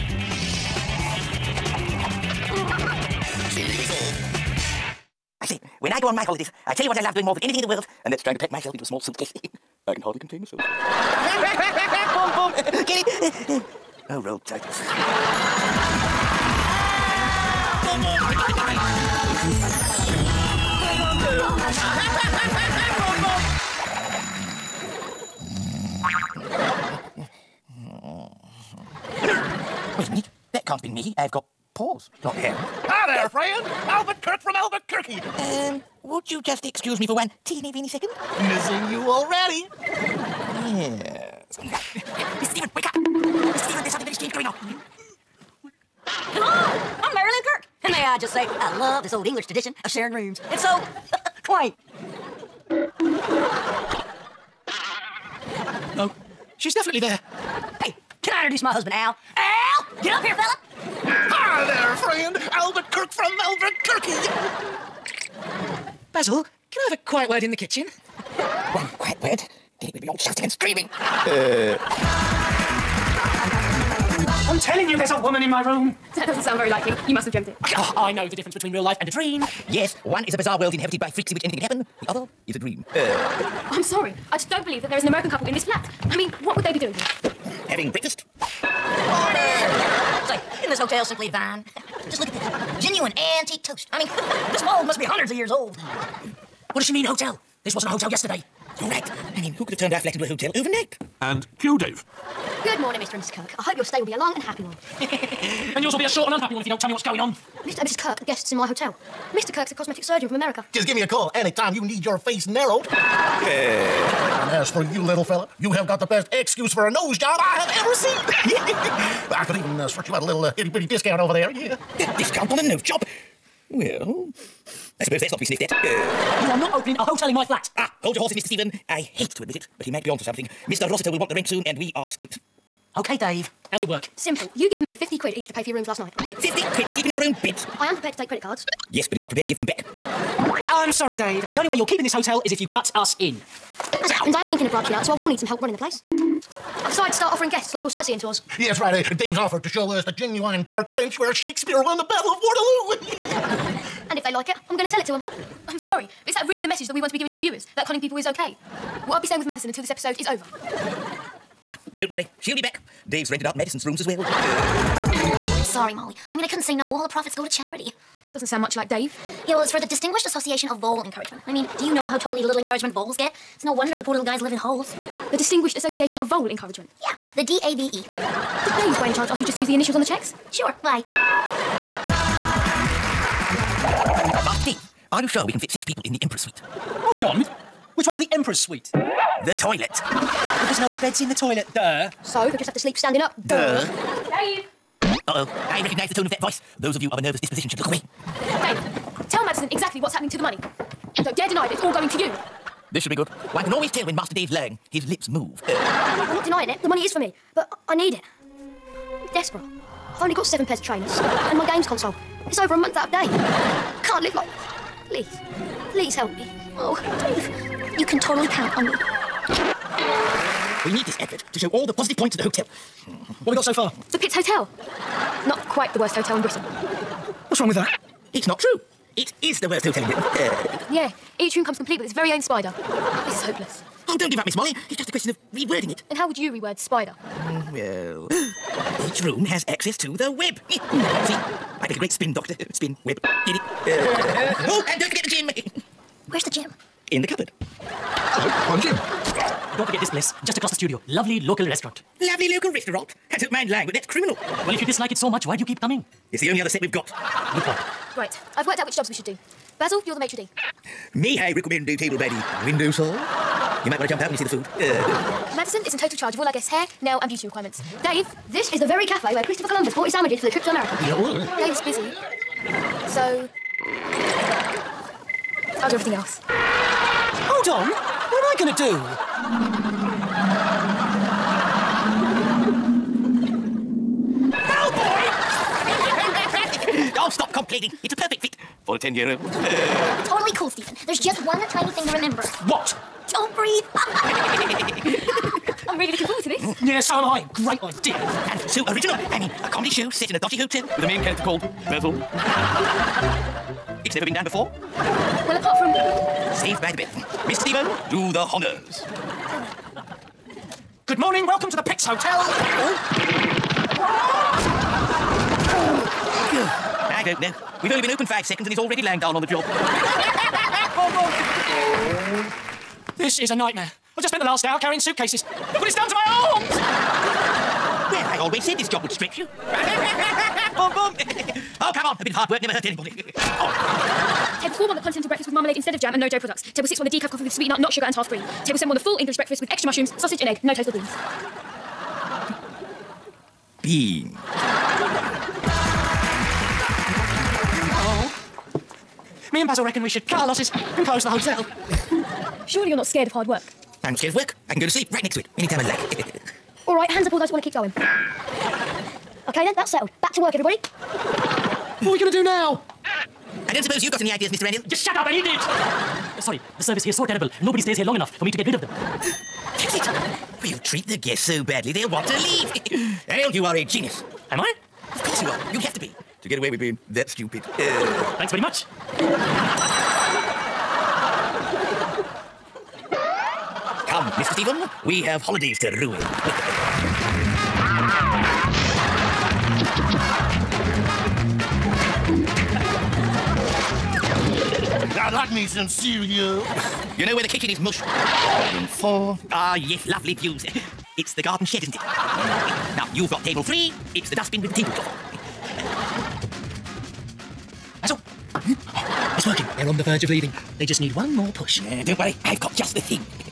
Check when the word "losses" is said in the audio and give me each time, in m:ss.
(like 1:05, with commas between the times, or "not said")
5:50.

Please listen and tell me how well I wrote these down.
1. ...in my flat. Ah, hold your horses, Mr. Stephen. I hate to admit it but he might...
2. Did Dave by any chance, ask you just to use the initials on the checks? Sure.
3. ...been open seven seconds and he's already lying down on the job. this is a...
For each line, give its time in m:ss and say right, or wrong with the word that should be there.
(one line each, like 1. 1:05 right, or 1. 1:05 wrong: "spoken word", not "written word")
1. 2:07 right
2. 2:57 right
3. 5:18 wrong: "five", not "seven".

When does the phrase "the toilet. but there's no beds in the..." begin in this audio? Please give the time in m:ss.
3:09.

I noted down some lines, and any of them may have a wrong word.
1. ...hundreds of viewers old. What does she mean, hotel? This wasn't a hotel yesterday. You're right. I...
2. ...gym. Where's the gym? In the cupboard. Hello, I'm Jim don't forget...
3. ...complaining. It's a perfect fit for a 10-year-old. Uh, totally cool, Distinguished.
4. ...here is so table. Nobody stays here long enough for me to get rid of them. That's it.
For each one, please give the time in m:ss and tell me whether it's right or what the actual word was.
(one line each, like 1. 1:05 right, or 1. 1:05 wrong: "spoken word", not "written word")
1. 1:35 wrong: "years", not "viewers"
2. 4:05 right
3. 4:47 wrong: "Stephen", not "Distinguished"
4. 6:07 wrong: "terrible", not "table".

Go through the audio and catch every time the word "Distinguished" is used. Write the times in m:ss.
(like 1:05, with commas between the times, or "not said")
2:49, 2:55.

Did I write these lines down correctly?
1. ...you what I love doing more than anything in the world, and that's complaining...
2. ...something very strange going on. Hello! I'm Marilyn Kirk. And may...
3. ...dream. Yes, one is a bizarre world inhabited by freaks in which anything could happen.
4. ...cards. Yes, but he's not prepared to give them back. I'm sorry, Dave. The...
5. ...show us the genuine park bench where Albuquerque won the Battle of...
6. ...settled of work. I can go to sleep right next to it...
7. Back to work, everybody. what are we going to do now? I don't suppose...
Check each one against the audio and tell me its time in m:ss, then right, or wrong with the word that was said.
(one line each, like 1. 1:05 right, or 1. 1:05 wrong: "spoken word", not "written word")
1. 0:06 wrong: "trying", not "complaining"
2. 0:43 right
3. 1:19 right
4. 2:18 right
5. 2:29 wrong: "Shakespeare", not "Albuquerque"
6. 5:54 wrong: "scared", not "settled"
7. 6:00 right.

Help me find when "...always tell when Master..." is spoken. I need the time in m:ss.
3:23.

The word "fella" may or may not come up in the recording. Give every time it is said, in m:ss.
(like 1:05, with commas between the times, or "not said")
1:00, 1:55.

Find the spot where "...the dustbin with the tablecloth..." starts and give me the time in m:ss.
6:44.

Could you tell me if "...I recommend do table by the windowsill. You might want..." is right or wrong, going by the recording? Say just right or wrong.
right.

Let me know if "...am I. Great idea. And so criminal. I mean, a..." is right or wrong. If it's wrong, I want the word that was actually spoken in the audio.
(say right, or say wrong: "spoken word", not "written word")
wrong: "original", not "criminal".